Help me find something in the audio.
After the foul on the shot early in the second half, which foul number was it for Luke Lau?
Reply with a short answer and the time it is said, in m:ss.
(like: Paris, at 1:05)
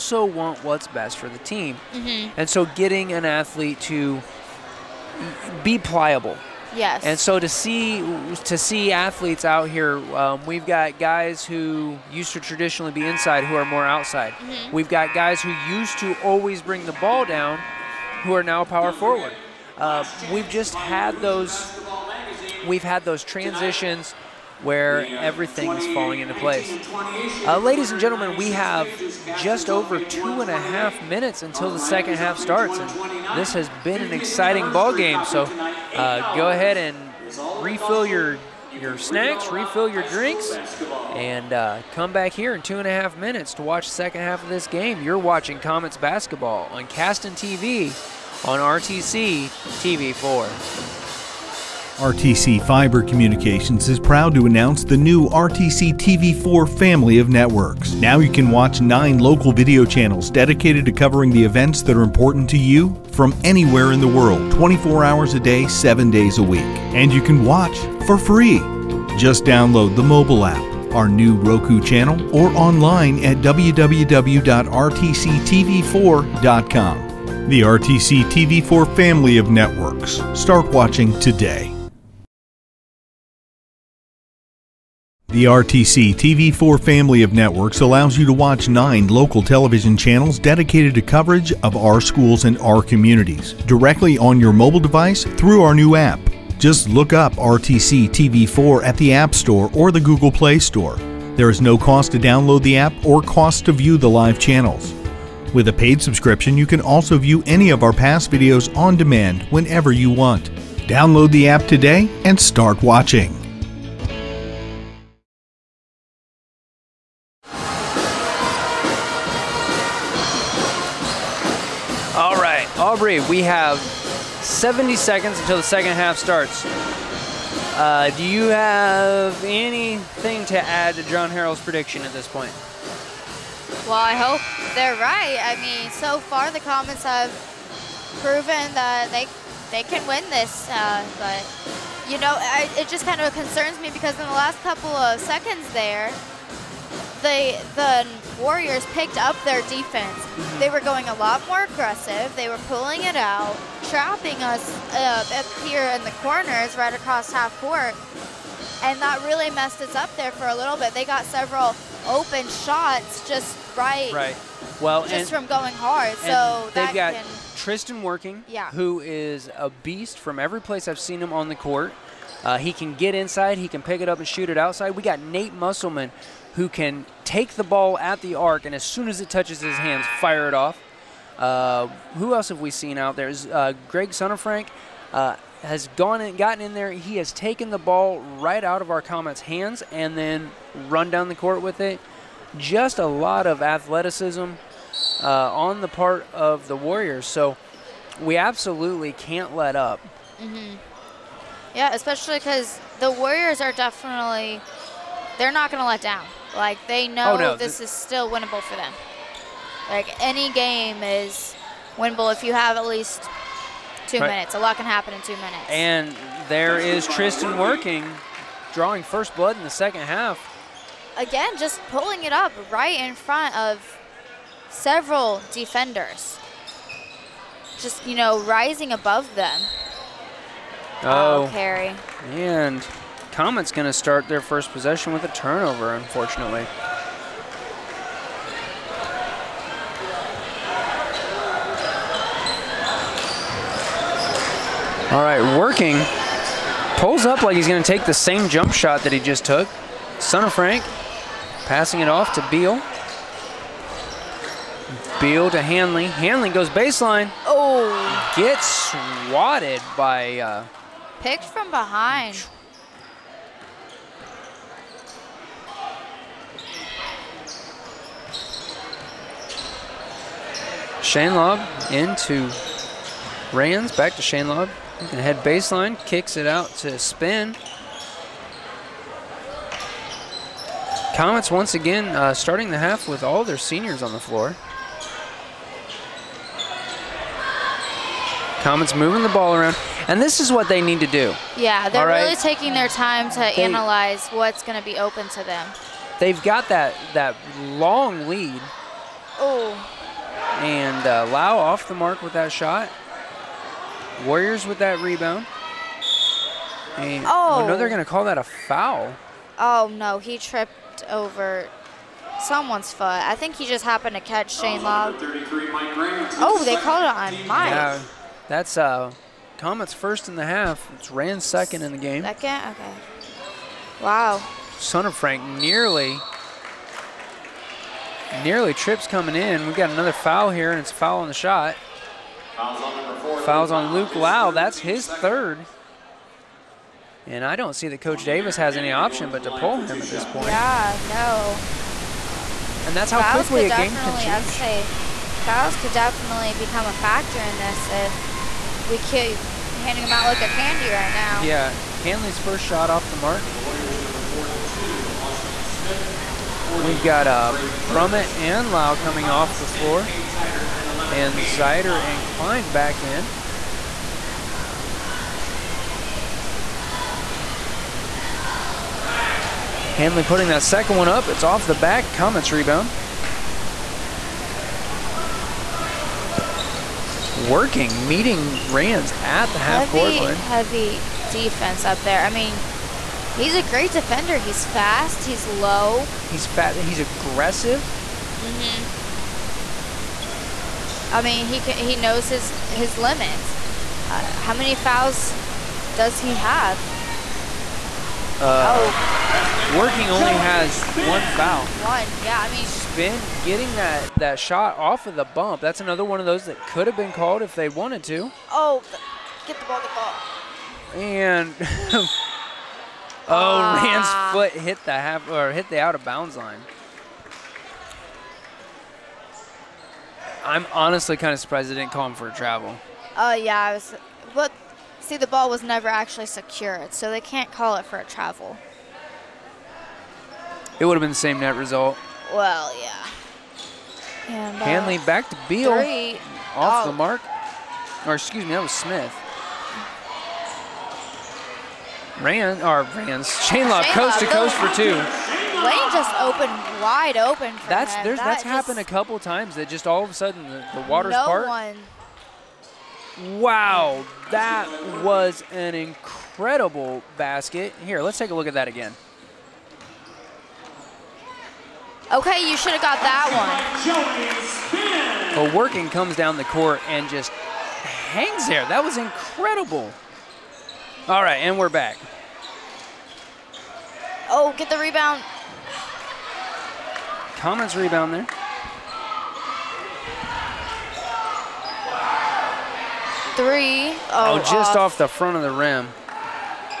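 3rd, at 5:35.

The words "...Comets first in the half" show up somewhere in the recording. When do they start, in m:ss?
5:19.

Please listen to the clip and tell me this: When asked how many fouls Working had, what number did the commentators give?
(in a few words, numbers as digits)
1.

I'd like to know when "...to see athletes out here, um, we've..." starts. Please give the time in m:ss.
0:08.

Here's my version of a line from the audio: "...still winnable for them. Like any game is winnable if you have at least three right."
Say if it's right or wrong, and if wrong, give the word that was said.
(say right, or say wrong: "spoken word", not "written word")
wrong: "two", not "three".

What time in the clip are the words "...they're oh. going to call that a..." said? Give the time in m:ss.
5:07.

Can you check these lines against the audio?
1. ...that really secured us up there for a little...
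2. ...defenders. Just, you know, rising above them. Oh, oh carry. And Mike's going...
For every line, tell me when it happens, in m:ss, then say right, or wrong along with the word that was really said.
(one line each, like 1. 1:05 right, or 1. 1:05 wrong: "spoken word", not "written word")
1. 2:39 wrong: "messed", not "secured"
2. 3:45 wrong: "Comet", not "Mike".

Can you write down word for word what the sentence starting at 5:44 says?
say fouls could definitely become a factor in this if we keep handing them out like they're candy right now.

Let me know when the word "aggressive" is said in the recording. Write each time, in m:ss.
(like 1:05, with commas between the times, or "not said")
2:31, 6:27.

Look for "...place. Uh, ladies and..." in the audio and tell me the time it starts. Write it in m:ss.
0:26.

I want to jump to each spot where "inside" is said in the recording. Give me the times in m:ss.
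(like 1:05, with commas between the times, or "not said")
0:13, 2:53.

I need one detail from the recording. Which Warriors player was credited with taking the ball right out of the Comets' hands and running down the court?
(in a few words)
Greg Sonnenfrank.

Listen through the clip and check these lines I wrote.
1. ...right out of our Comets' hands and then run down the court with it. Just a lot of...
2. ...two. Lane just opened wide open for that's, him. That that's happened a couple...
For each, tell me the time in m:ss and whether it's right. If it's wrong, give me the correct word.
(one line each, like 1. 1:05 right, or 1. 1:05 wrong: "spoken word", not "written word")
1. 3:08 right
2. 7:24 right.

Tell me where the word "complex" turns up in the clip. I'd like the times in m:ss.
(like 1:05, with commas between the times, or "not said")
not said.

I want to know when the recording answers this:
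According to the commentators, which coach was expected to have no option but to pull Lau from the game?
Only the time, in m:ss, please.
5:38.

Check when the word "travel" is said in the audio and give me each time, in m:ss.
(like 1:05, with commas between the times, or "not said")
7:02, 7:08.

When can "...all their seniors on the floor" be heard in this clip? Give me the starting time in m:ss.
4:43.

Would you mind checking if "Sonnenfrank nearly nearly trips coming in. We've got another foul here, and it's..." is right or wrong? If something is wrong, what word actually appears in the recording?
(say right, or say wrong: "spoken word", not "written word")
right.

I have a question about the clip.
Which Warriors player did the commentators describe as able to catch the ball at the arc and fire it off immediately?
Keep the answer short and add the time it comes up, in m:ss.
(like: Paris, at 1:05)
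Nate Musselman, at 2:55.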